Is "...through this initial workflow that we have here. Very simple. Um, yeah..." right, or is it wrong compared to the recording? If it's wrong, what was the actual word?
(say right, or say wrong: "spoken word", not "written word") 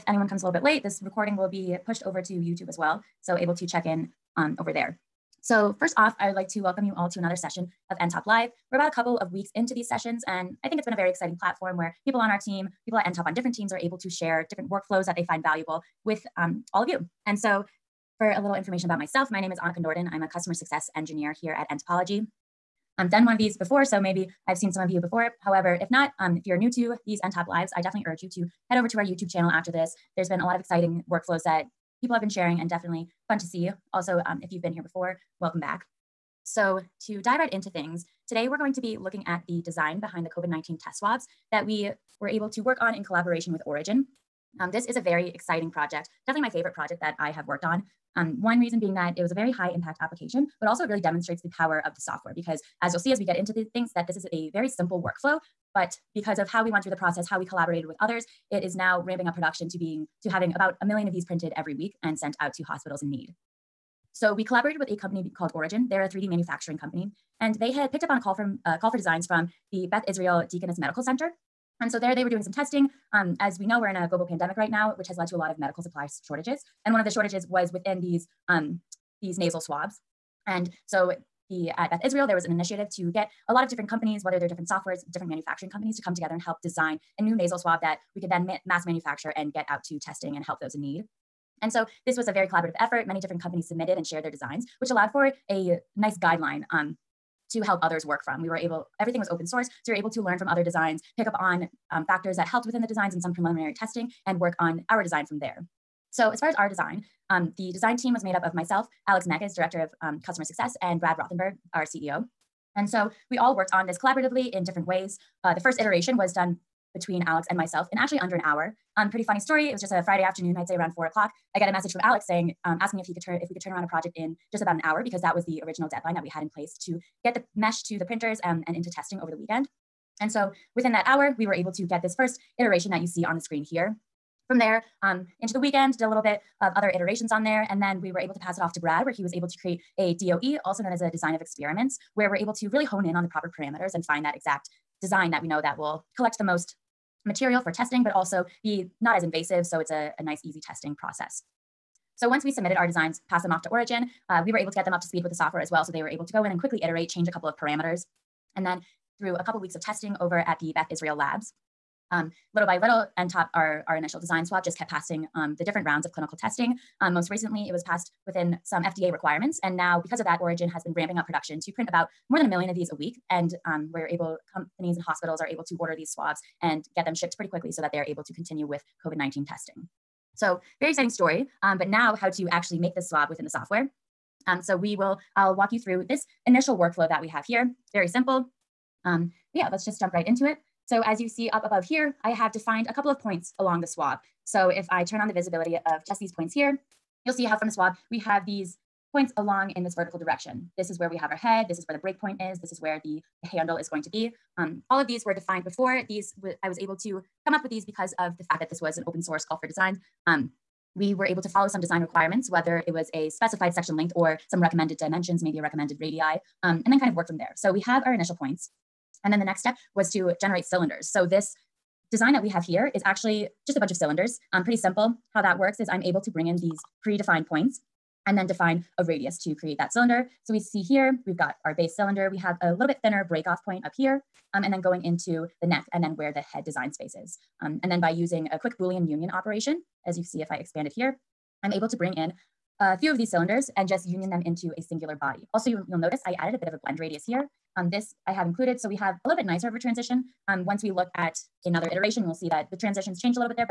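right.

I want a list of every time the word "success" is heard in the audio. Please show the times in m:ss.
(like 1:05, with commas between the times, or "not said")
0:20, 1:50.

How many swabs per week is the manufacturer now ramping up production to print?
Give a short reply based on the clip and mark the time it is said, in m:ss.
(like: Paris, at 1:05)
more than 1 million, at 2:52.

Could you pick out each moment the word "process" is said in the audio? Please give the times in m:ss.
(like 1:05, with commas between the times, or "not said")
0:56, 2:30.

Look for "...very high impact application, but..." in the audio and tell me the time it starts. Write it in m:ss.
0:49.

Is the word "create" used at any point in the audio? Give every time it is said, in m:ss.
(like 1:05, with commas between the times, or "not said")
2:19, 3:49.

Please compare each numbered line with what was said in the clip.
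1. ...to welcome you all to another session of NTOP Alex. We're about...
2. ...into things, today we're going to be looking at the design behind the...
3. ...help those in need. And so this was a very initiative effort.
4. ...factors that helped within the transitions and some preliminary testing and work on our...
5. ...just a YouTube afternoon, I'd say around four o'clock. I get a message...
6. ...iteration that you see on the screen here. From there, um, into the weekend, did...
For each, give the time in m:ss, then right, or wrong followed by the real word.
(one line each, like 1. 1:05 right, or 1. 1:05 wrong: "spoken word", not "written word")
1. 0:06 wrong: "Live", not "Alex"
2. 0:37 right
3. 1:30 wrong: "collaborative", not "initiative"
4. 1:42 wrong: "designs", not "transitions"
5. 1:59 wrong: "Friday", not "YouTube"
6. 2:12 right.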